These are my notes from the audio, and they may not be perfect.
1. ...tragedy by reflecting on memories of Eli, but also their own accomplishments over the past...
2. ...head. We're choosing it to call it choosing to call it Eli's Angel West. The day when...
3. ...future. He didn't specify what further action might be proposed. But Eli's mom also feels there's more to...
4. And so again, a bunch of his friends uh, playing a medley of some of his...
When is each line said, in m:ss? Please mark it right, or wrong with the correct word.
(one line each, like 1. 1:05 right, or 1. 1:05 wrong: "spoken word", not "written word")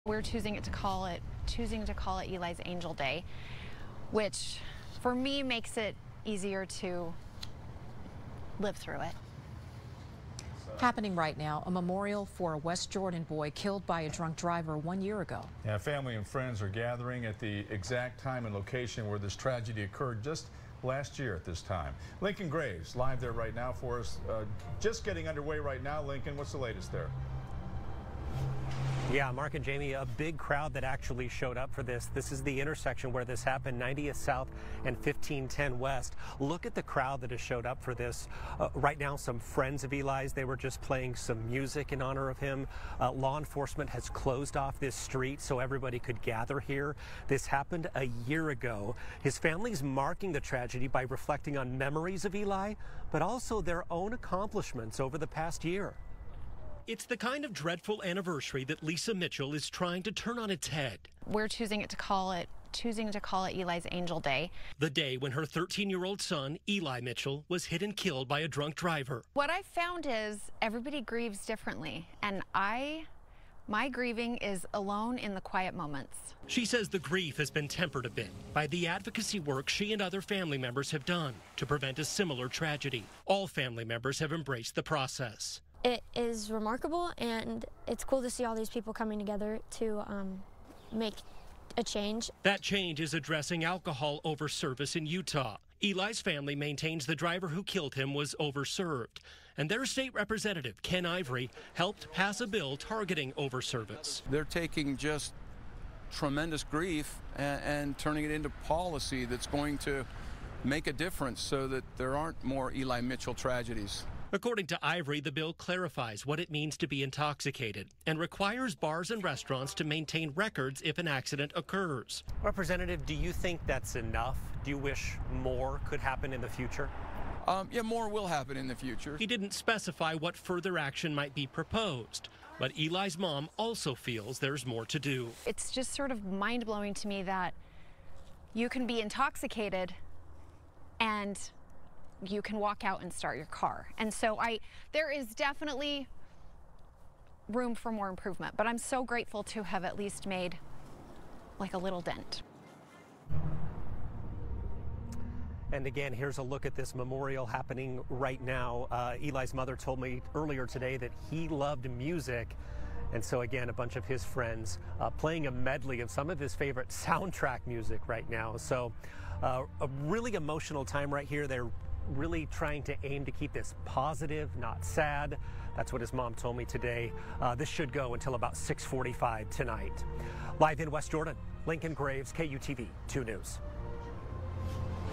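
1. 0:50 right
2. 1:00 wrong: "Day", not "West"
3. 2:08 right
4. 2:43 right.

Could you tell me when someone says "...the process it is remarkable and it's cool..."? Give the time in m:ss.
1:24.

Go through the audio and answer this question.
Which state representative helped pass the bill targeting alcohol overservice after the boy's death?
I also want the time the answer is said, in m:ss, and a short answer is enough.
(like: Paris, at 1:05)
Ken Ivory, at 1:40.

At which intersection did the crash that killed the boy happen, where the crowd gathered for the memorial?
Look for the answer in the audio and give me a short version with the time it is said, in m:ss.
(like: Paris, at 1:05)
90th South and 1510 West, at 0:33.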